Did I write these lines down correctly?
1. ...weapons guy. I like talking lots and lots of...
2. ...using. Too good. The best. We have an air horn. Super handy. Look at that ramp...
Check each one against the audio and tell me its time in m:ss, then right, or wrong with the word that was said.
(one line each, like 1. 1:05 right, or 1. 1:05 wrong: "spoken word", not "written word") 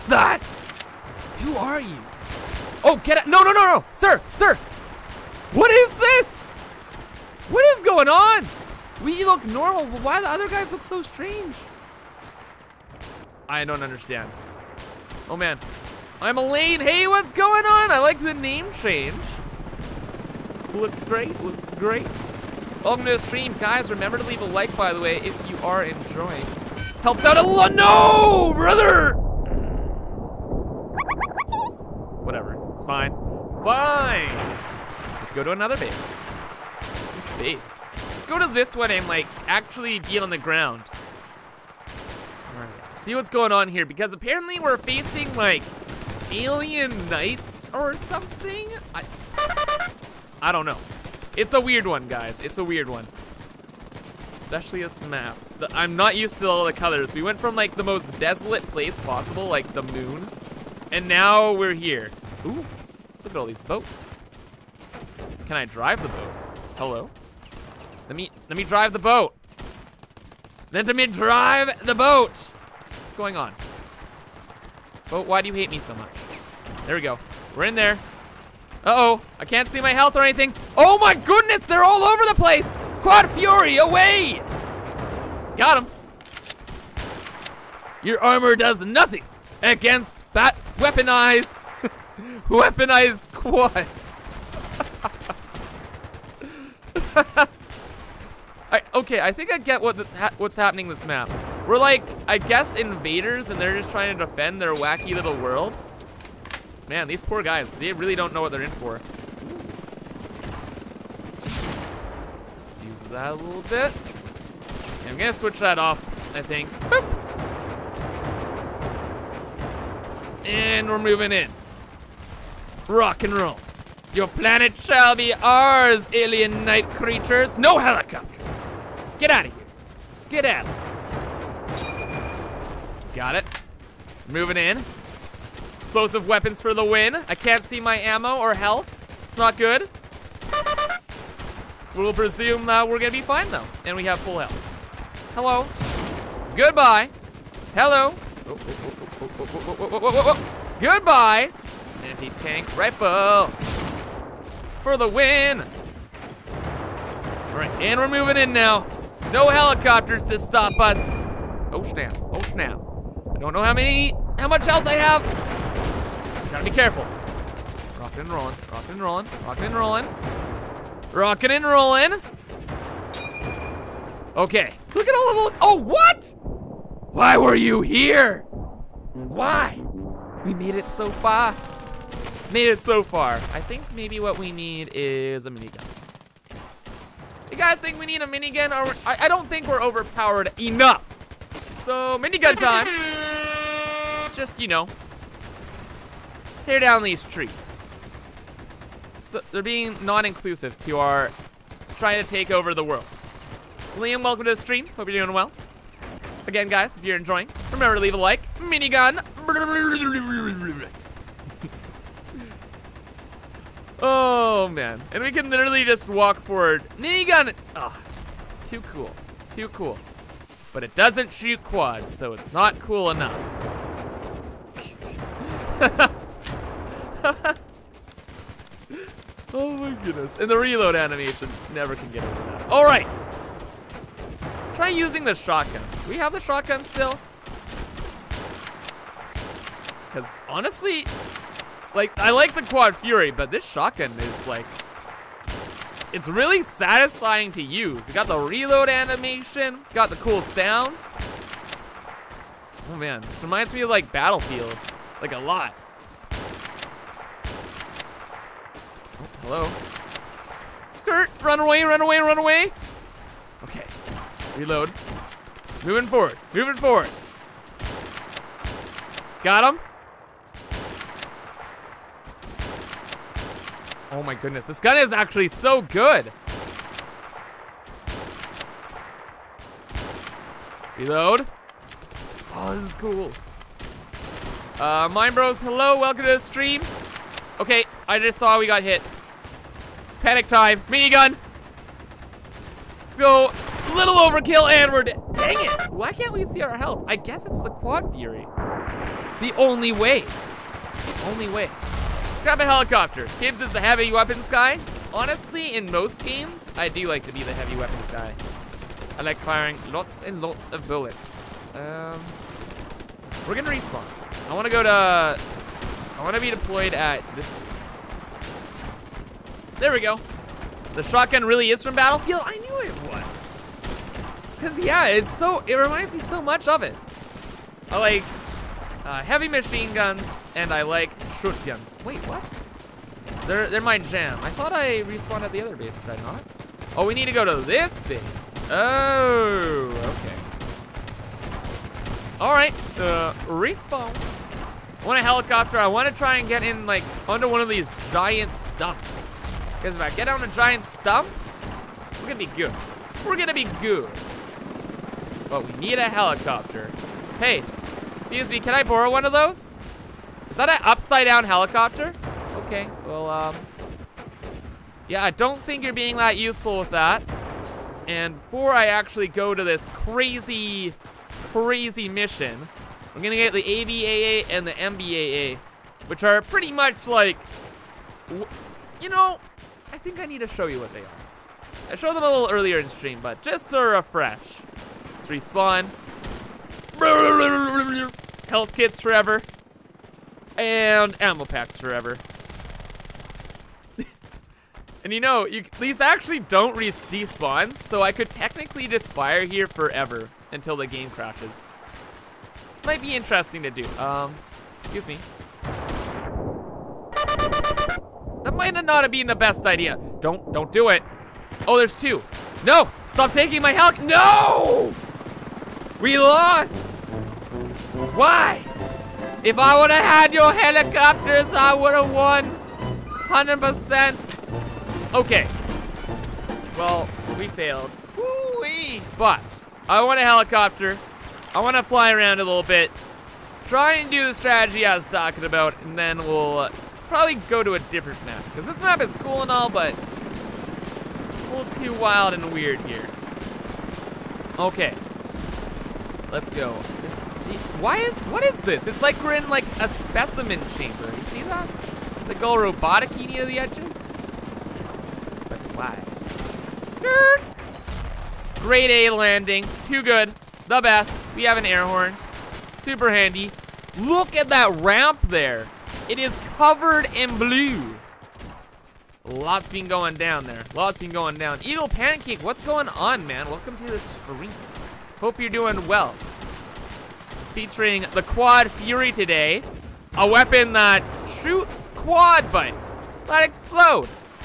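1. 5:07 wrong: "firing", not "talking"
2. 7:39 wrong: "landing", not "using".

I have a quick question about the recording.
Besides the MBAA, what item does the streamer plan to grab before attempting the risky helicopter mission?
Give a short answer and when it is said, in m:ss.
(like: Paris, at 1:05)
ABAA, at 6:13.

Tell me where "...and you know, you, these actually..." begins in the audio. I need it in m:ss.
6:35.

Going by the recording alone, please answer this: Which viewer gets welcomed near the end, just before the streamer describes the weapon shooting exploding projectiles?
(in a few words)
Eagle Pancake.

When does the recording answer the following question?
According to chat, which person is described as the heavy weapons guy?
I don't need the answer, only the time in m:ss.
5:03.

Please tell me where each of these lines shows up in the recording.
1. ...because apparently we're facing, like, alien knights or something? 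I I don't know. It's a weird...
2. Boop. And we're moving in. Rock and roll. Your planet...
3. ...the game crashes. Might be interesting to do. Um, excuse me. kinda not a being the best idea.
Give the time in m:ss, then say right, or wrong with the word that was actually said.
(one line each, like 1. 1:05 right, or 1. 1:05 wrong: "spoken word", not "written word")
1. 0:43 right
2. 1:56 right
3. 6:40 right.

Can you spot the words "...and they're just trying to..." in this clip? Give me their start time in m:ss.
1:43.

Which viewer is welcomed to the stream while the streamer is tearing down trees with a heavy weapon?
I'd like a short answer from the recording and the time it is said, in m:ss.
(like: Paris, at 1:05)
Liam, at 3:23.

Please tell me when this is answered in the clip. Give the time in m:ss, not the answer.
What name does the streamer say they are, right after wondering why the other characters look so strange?
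0:16.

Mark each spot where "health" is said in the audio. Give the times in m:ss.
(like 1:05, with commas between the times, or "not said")
1:19, 2:18, 2:24, 2:44, 4:56, 6:28, 6:53.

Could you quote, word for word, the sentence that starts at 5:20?
The shotgun really is from Battlefield?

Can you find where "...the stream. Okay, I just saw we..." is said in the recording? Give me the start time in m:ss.
4:46.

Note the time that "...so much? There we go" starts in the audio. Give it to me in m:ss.
1:15.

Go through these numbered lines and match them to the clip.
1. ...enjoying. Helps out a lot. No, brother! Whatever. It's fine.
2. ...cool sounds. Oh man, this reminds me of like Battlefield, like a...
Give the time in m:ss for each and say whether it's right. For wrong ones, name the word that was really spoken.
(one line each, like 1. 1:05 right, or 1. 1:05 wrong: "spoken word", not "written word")
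1. 0:25 right
2. 4:10 right.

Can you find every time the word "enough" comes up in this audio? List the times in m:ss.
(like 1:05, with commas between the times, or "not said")
3:10, 3:43.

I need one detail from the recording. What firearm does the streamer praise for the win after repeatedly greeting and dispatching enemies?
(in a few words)
Anti tank rifle.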